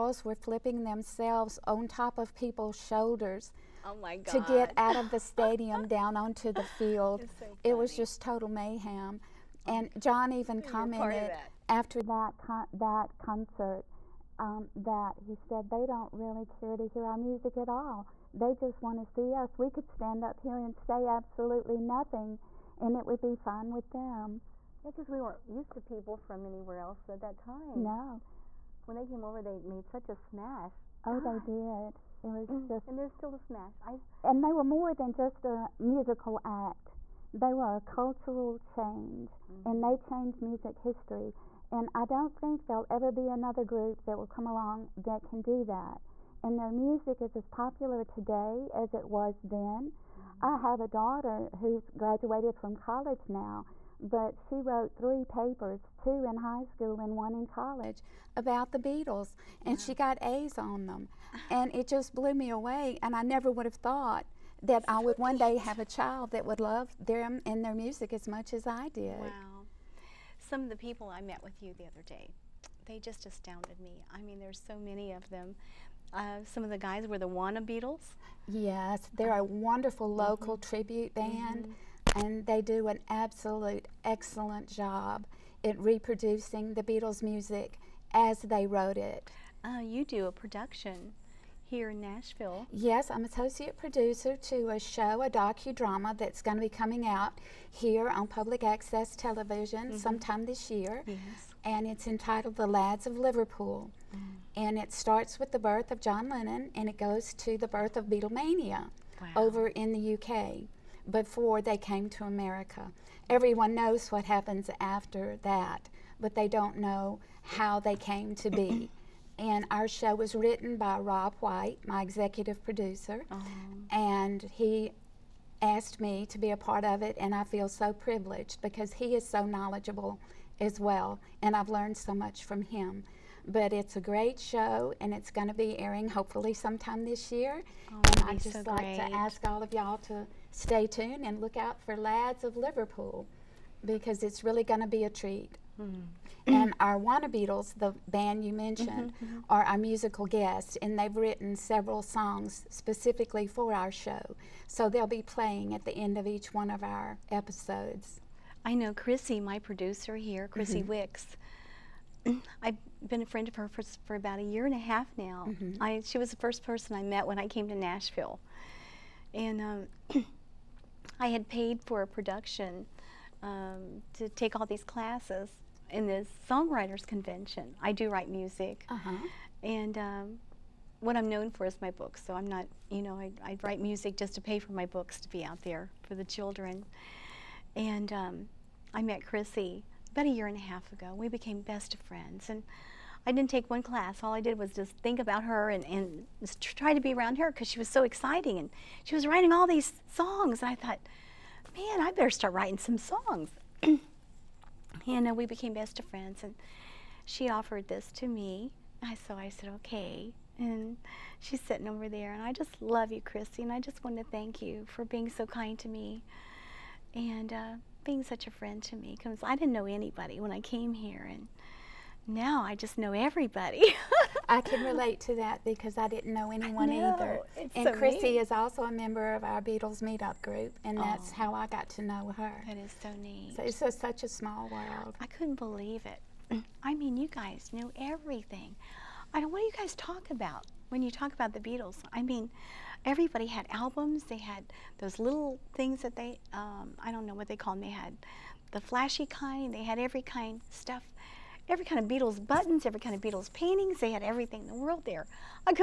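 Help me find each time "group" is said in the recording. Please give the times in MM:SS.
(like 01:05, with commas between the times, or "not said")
00:43, 03:50.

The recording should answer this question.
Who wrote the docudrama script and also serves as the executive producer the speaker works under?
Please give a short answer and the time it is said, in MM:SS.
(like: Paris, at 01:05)
Rob White, at 02:00.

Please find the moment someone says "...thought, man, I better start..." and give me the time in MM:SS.
03:20.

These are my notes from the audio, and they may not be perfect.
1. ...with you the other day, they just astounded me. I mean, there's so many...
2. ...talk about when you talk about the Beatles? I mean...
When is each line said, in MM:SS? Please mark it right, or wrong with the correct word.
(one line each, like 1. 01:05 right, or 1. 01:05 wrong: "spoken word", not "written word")
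1. 01:11 right
2. 03:59 right.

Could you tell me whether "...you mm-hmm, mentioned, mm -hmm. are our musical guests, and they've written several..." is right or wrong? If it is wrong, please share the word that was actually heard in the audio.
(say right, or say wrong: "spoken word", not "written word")
right.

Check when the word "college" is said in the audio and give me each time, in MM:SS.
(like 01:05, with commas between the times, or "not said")
00:52, 00:57.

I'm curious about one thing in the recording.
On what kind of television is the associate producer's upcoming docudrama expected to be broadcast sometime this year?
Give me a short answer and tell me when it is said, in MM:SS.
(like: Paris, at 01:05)
Public access television, at 01:38.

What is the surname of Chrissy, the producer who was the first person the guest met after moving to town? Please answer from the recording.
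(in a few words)
Wicks.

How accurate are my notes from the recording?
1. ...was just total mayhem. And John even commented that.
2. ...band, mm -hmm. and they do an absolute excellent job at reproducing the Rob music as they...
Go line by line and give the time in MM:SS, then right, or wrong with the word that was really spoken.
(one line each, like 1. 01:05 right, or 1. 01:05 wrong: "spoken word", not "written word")
1. 00:07 right
2. 01:21 wrong: "Beatles", not "Rob".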